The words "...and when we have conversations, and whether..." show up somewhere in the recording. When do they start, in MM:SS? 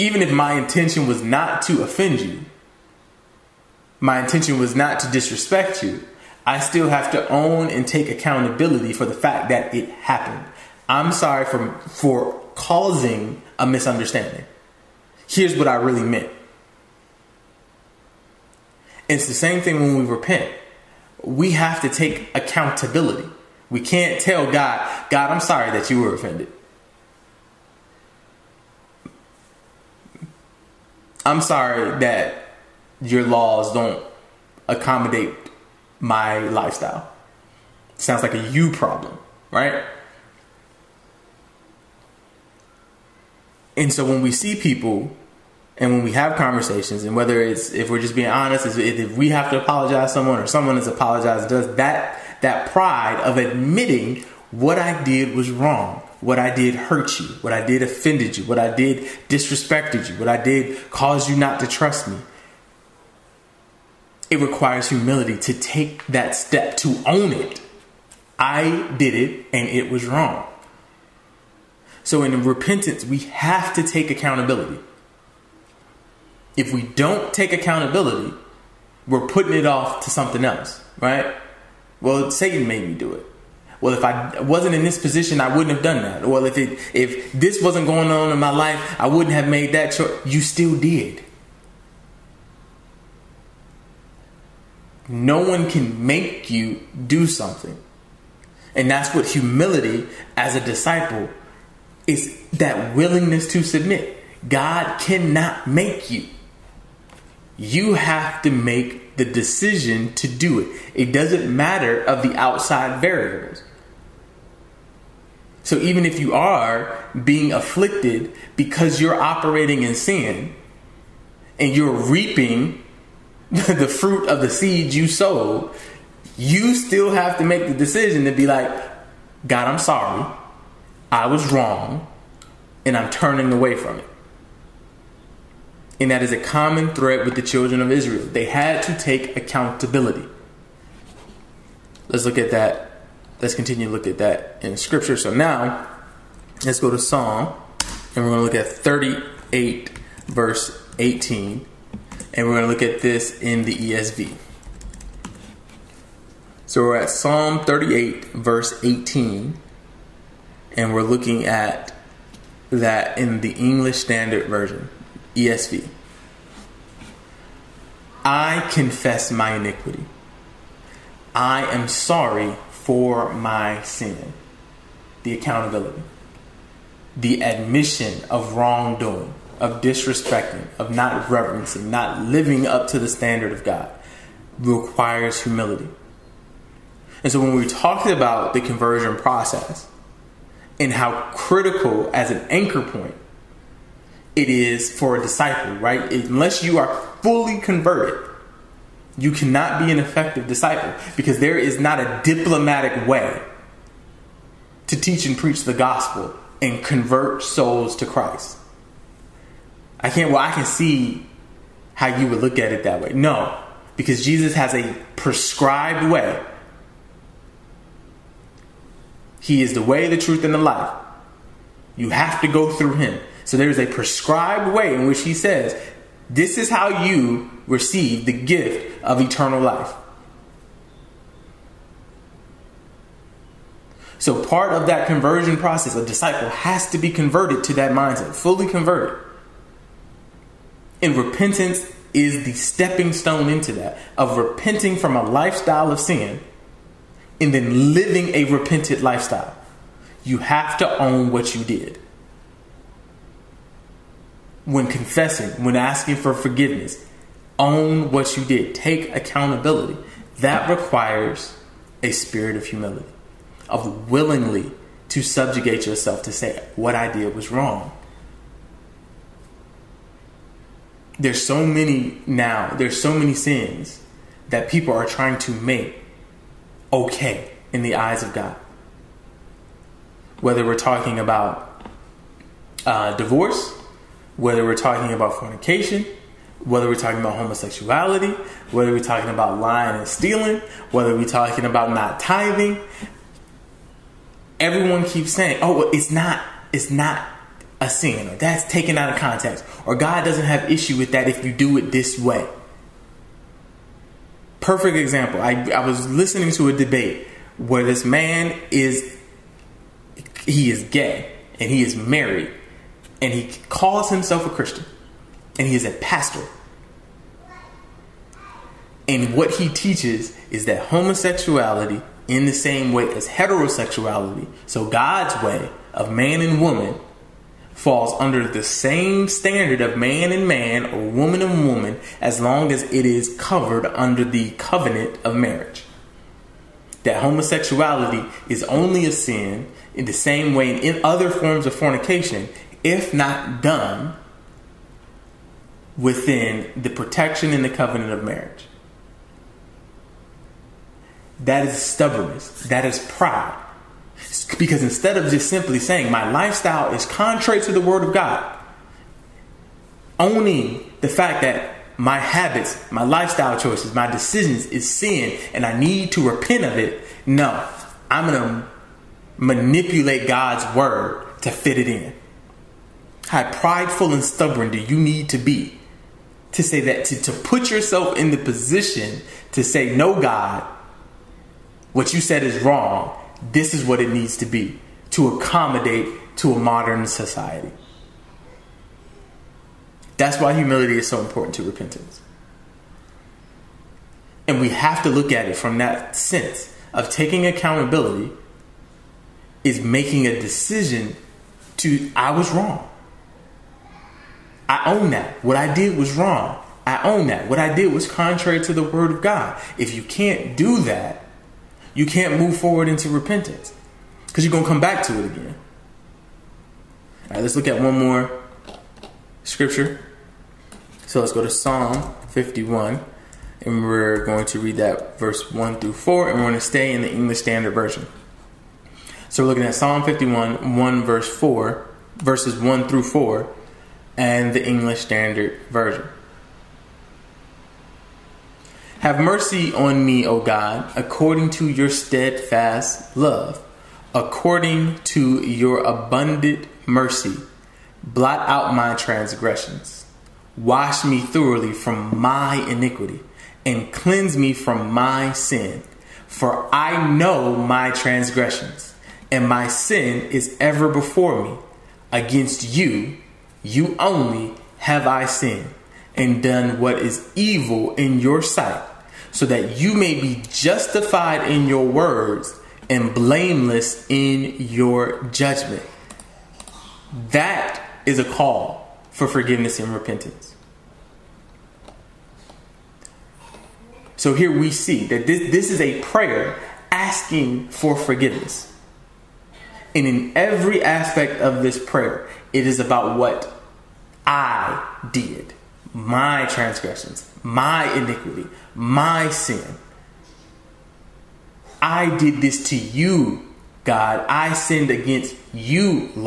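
00:45.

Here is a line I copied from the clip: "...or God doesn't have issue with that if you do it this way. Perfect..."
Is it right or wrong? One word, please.
right.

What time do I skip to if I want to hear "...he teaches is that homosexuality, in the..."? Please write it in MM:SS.
05:19.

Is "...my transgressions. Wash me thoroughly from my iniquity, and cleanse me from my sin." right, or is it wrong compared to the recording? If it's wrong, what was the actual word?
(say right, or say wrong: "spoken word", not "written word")
right.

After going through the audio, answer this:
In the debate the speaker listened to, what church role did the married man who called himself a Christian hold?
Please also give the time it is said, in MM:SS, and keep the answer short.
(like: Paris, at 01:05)
Pastor, at 05:15.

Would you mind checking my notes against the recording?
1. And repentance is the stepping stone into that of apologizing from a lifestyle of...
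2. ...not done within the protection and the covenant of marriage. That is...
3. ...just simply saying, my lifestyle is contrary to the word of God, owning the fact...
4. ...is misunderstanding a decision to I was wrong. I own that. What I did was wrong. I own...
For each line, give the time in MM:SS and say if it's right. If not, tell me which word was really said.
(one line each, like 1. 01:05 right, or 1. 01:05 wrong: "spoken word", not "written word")
1. 04:01 wrong: "repenting", not "apologizing"
2. 05:43 right
3. 05:55 right
4. 06:39 wrong: "making", not "misunderstanding".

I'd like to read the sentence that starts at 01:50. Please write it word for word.
It doesn't matter of the outside variables.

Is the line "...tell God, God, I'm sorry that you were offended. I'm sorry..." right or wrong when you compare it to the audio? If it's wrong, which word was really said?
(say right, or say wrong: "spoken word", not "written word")
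right.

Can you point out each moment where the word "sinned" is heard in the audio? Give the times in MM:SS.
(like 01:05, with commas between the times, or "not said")
07:45, 08:24.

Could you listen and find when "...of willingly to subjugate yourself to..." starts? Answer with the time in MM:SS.
04:23.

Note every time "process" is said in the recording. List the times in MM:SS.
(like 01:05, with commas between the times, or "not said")
03:09, 03:55.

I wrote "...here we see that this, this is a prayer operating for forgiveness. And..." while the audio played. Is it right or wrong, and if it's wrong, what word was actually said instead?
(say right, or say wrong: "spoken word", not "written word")
wrong: "asking", not "operating".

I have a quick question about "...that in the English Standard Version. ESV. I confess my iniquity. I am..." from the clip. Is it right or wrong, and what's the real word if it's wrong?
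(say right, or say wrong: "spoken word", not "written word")
right.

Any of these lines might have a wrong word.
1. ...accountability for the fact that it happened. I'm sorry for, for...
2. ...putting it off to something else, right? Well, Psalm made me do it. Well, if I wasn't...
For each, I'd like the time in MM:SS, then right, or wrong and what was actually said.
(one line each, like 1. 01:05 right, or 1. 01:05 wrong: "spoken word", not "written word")
1. 00:08 right
2. 01:19 wrong: "Satan", not "Psalm".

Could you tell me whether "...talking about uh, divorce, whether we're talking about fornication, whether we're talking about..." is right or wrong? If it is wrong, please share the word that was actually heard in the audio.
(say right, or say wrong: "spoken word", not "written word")
right.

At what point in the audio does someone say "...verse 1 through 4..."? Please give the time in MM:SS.
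07:05.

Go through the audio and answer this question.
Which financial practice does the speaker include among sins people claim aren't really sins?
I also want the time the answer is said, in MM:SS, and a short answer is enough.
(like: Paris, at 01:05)
Not tithing, at 04:51.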